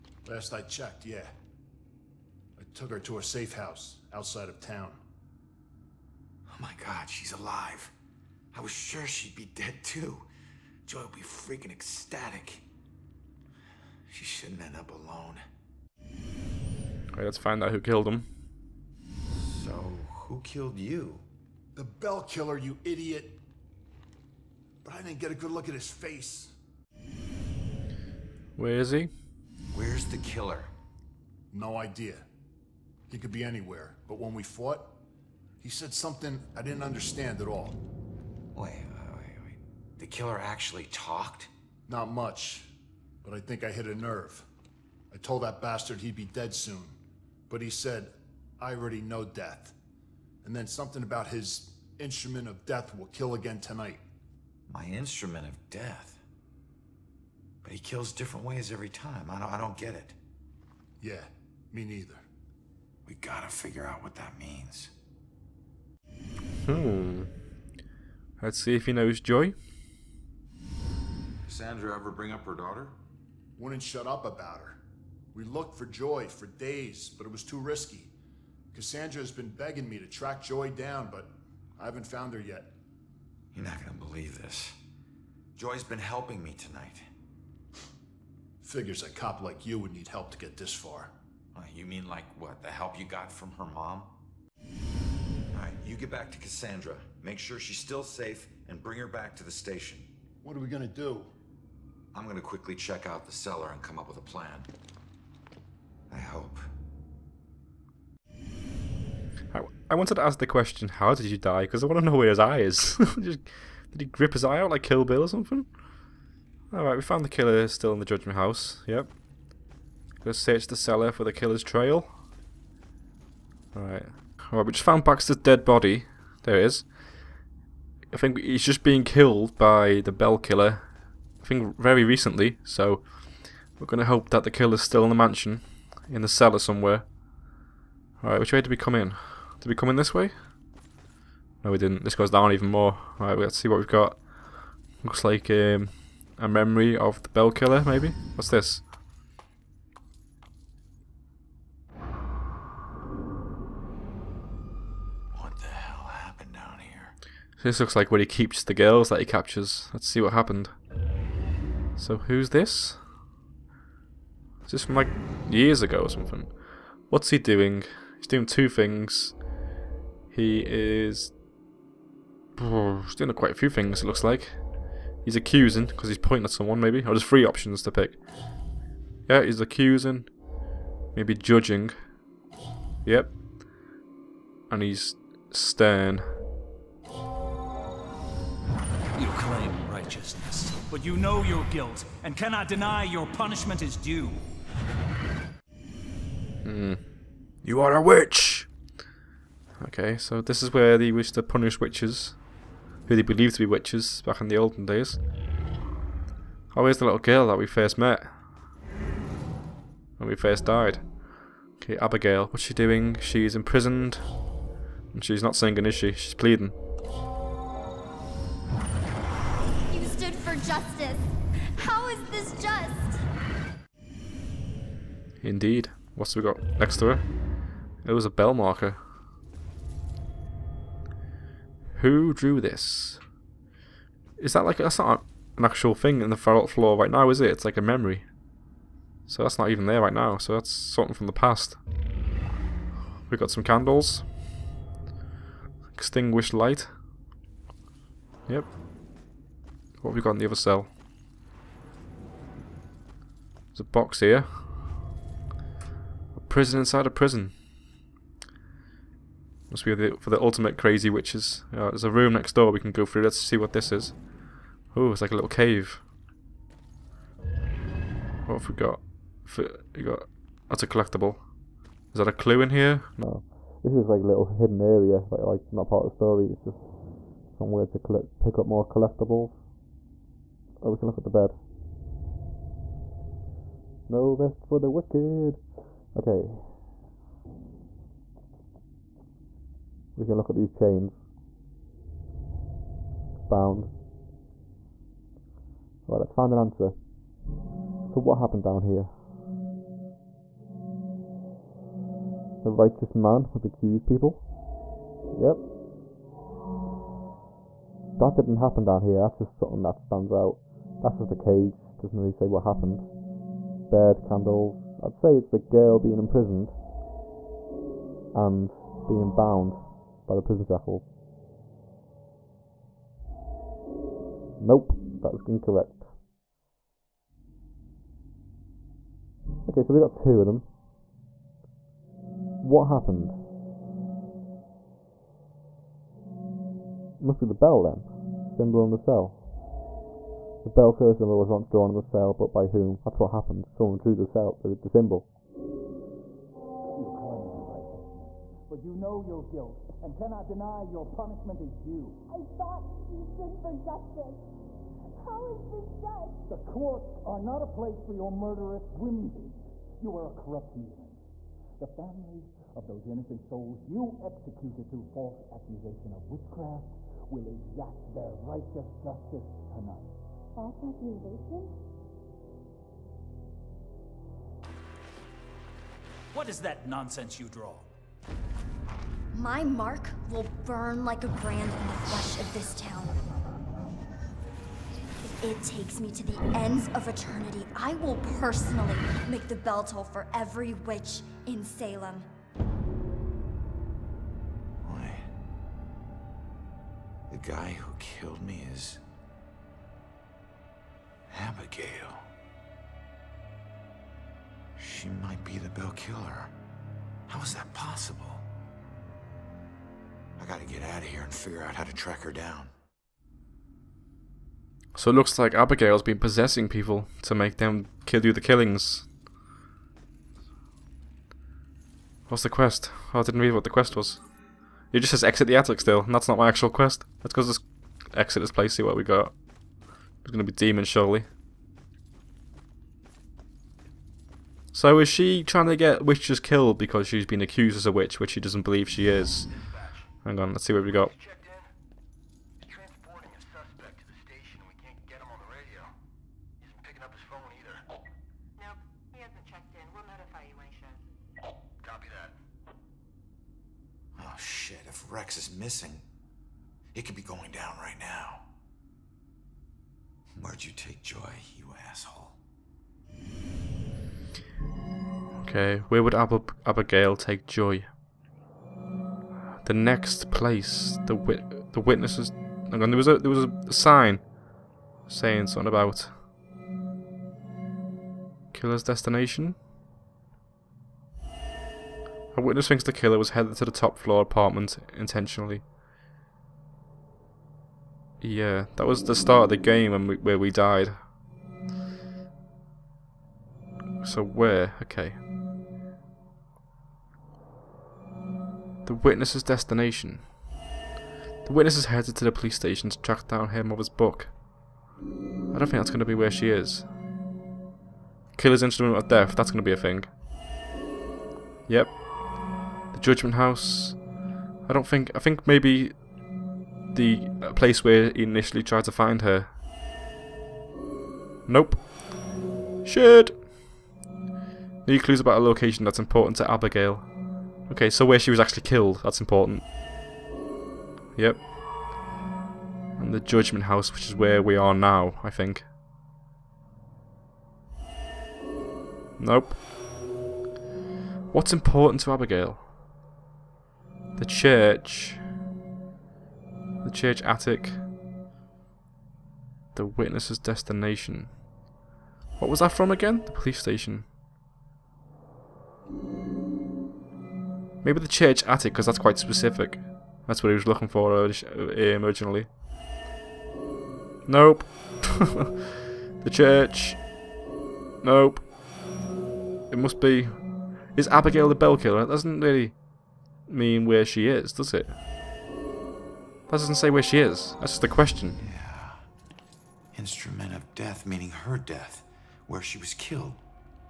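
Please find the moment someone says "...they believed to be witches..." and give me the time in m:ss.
3:23.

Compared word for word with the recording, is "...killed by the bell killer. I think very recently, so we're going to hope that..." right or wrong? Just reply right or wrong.
right.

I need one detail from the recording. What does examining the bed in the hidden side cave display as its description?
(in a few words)
No rest for the wicked.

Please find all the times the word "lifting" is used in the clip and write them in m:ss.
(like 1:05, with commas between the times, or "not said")
not said.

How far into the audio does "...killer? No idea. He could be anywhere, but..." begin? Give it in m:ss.
0:30.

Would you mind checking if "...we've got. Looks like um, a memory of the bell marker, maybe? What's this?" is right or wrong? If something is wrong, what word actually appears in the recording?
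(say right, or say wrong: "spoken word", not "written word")
wrong: "killer", not "marker".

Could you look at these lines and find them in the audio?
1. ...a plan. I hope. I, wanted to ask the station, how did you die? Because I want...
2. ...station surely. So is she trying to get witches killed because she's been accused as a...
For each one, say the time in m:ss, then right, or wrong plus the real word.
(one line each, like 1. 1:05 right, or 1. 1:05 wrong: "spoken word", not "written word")
1. 1:44 wrong: "question", not "station"
2. 7:10 wrong: "demon", not "station".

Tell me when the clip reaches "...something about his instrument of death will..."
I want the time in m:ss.
0:50.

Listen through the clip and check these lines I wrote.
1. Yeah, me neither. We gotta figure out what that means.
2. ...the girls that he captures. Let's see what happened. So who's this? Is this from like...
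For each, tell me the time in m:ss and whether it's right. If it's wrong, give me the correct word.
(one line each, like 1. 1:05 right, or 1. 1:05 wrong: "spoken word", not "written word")
1. 1:01 right
2. 2:38 right.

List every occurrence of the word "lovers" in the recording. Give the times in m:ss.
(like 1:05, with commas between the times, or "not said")
not said.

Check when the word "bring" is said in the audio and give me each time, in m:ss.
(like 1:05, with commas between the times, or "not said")
1:12, 1:38.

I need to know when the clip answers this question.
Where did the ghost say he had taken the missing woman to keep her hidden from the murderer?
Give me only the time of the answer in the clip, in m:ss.
0:03.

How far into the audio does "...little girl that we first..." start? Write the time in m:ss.
3:27.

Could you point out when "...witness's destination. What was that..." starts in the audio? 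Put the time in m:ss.
9:09.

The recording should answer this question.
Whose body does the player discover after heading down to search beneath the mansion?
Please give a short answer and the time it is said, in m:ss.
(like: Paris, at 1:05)
Baxter, at 2:05.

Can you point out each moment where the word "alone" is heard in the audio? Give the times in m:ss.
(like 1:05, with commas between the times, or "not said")
0:14.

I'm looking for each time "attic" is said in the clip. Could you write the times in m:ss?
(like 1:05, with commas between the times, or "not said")
7:05, 9:07, 9:18.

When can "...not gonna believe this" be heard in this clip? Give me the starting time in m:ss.
1:23.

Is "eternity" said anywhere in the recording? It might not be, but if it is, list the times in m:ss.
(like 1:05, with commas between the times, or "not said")
6:27.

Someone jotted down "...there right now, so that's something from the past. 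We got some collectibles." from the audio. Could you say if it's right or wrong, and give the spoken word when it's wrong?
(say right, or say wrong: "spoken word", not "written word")
wrong: "candles", not "collectibles".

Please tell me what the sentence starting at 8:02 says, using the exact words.
A witness thinks the killer was headed to the top floor apartment intentionally.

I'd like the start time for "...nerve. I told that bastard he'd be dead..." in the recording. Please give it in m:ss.
0:43.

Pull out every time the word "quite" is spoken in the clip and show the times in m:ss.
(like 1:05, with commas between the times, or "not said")
2:53, 9:18.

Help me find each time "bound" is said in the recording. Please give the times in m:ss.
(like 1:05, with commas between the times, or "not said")
4:53, 5:19.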